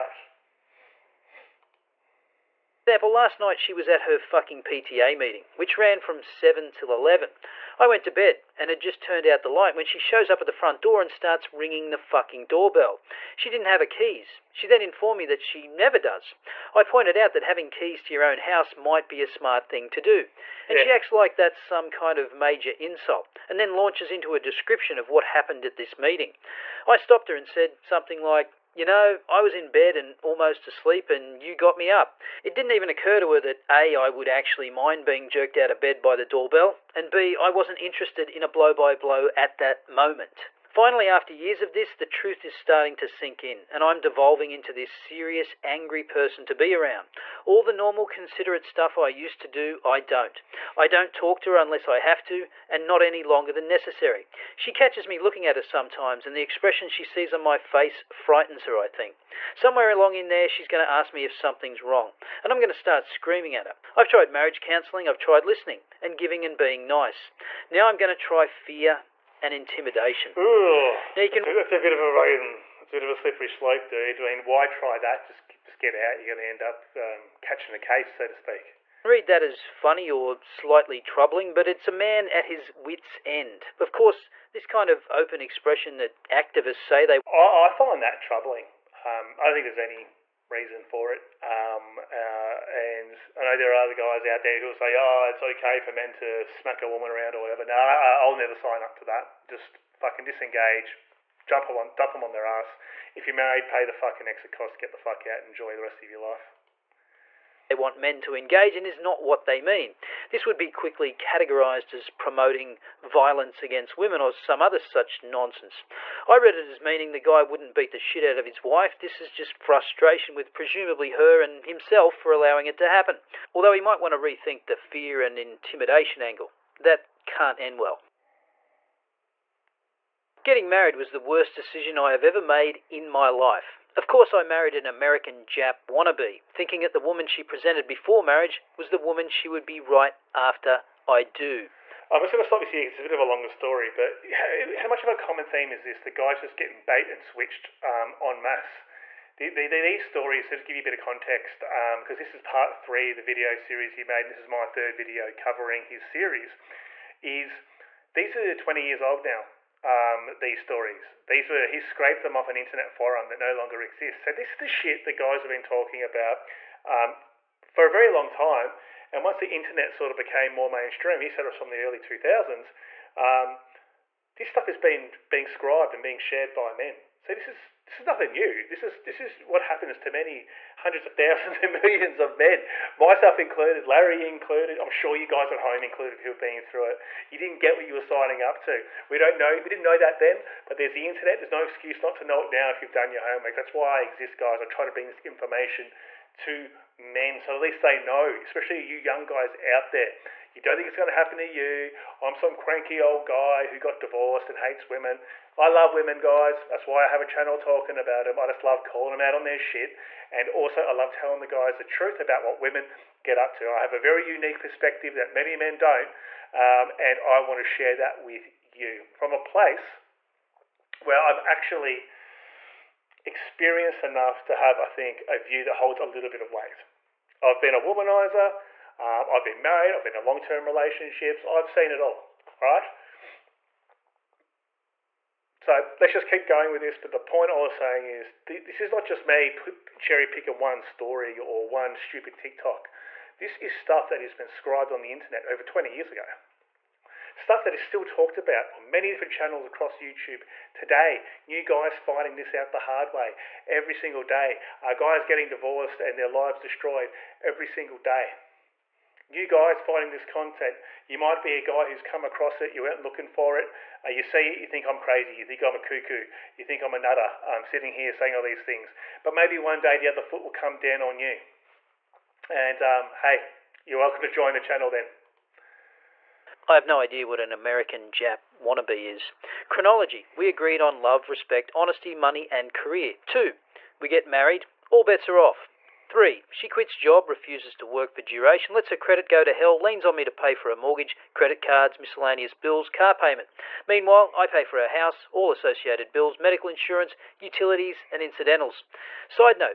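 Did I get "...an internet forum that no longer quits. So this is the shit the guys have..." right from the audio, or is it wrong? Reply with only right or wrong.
wrong.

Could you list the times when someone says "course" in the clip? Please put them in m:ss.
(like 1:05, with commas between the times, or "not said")
1:23, 2:14.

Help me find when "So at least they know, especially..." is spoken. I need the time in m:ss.
3:17.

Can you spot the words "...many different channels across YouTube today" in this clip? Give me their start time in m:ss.
4:08.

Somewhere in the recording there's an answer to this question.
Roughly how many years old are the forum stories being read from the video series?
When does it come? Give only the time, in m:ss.
2:38.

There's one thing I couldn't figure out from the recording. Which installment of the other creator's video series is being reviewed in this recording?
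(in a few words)
Part three.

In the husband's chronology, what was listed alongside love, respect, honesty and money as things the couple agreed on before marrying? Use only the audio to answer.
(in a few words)
Career.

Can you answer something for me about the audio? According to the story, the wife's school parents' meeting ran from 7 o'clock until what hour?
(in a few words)
11.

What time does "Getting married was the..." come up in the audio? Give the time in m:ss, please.
2:10.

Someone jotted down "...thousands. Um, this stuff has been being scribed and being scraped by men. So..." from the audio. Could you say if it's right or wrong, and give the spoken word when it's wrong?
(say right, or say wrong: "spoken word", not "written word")
wrong: "shared", not "scraped".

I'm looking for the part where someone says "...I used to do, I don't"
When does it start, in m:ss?
0:48.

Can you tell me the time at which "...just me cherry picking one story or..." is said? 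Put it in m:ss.
3:59.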